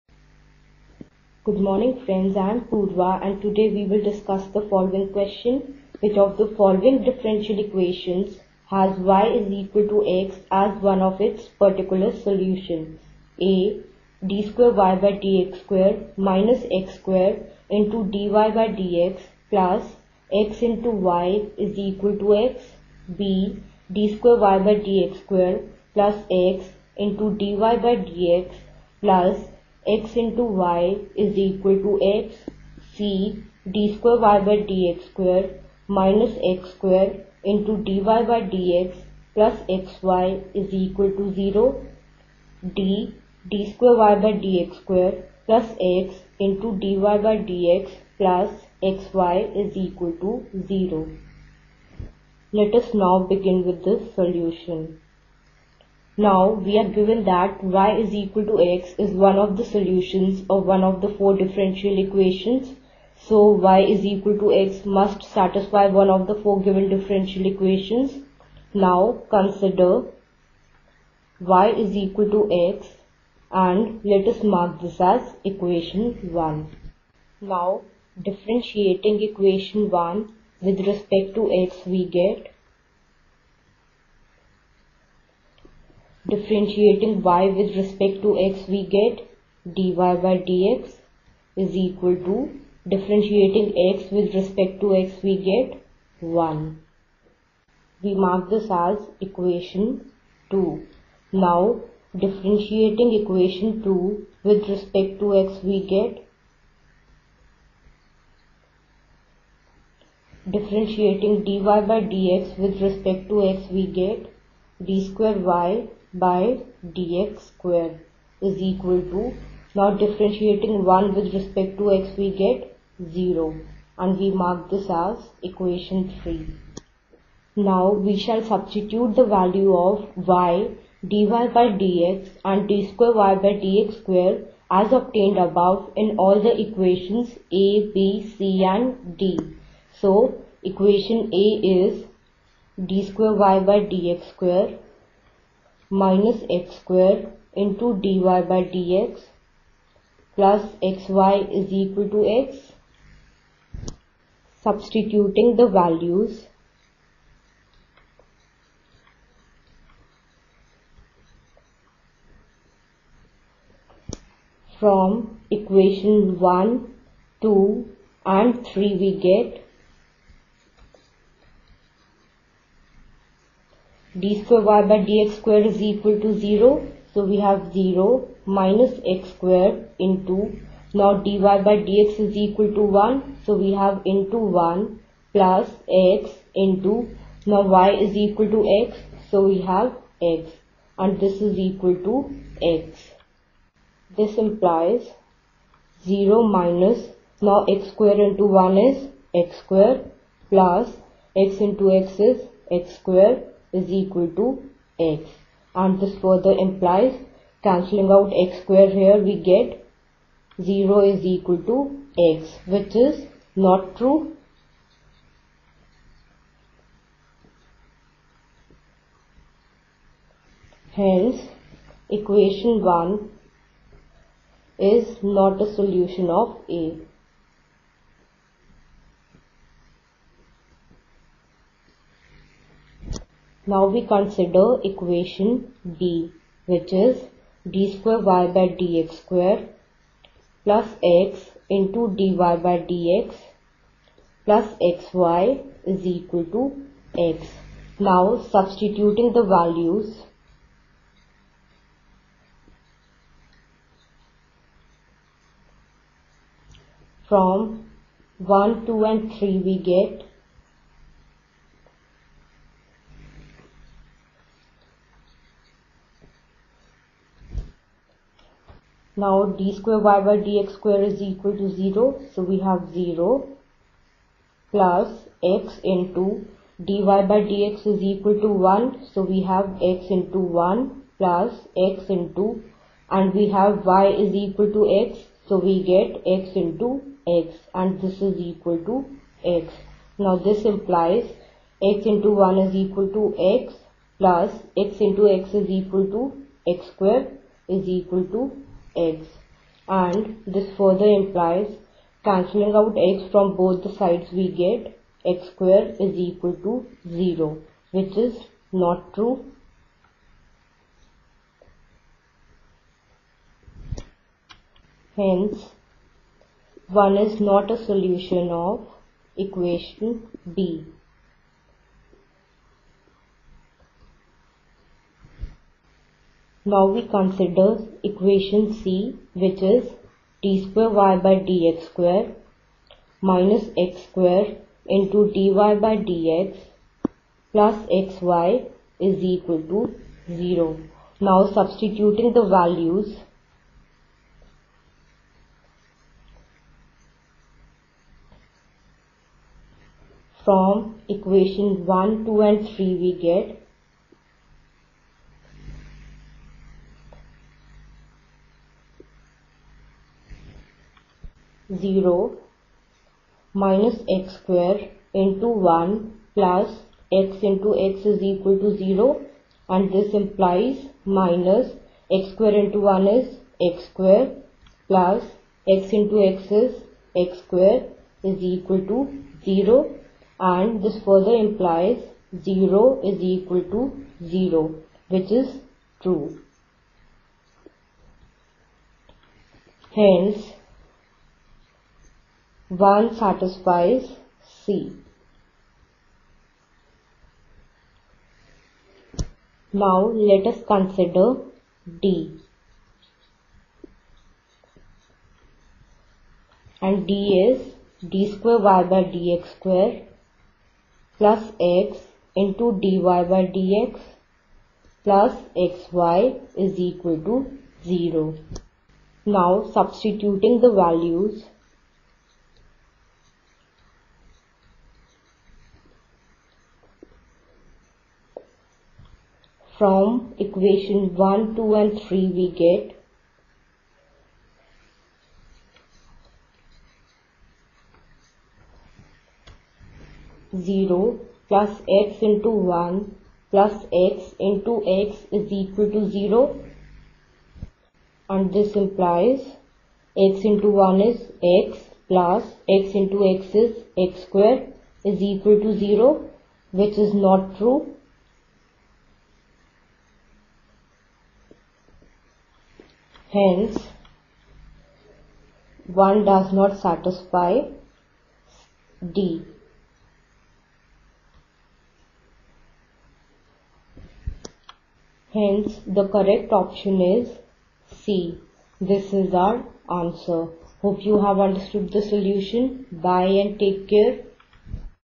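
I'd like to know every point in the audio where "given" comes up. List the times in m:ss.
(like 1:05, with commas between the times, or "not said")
0:56, 1:06.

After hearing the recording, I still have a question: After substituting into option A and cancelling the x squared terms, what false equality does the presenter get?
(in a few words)
0 = x.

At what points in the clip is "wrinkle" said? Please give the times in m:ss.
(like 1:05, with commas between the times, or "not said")
not said.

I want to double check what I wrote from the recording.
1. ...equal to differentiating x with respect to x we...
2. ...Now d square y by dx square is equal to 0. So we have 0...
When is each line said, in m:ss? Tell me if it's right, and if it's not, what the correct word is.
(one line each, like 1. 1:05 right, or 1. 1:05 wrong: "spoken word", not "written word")
1. 1:31 right
2. 4:29 right.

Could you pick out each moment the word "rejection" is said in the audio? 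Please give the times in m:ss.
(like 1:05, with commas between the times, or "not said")
not said.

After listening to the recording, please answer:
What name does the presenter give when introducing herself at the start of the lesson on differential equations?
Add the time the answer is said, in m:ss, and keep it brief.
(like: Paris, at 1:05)
Purva, at 0:02.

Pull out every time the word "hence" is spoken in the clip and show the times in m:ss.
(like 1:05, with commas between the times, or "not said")
3:40, 5:15, 6:29, 7:43, 7:55.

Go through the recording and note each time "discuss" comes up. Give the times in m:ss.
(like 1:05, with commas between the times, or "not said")
0:04.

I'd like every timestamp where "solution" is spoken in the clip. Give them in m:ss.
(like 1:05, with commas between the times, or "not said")
0:12, 0:54, 0:59, 3:45, 5:17, 8:02.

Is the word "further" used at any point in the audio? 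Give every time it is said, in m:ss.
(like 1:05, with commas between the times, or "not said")
3:26, 5:00, 6:21.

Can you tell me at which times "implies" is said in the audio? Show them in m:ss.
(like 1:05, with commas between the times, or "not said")
3:14, 3:26, 4:50, 5:01, 6:10, 6:21, 7:28.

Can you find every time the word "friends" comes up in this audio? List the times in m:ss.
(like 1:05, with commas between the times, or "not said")
0:02.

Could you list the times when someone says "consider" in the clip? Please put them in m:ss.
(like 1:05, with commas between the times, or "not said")
1:09, 3:54, 5:27, 6:40.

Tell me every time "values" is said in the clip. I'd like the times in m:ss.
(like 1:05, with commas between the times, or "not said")
2:09, 2:35, 4:09, 5:42, 7:00.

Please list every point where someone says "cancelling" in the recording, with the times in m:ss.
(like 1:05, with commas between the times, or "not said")
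3:27, 5:02.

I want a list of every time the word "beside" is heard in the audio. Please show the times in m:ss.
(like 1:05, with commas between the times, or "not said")
not said.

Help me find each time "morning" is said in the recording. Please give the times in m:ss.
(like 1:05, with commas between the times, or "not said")
0:01.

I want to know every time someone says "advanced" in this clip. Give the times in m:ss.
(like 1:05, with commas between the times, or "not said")
not said.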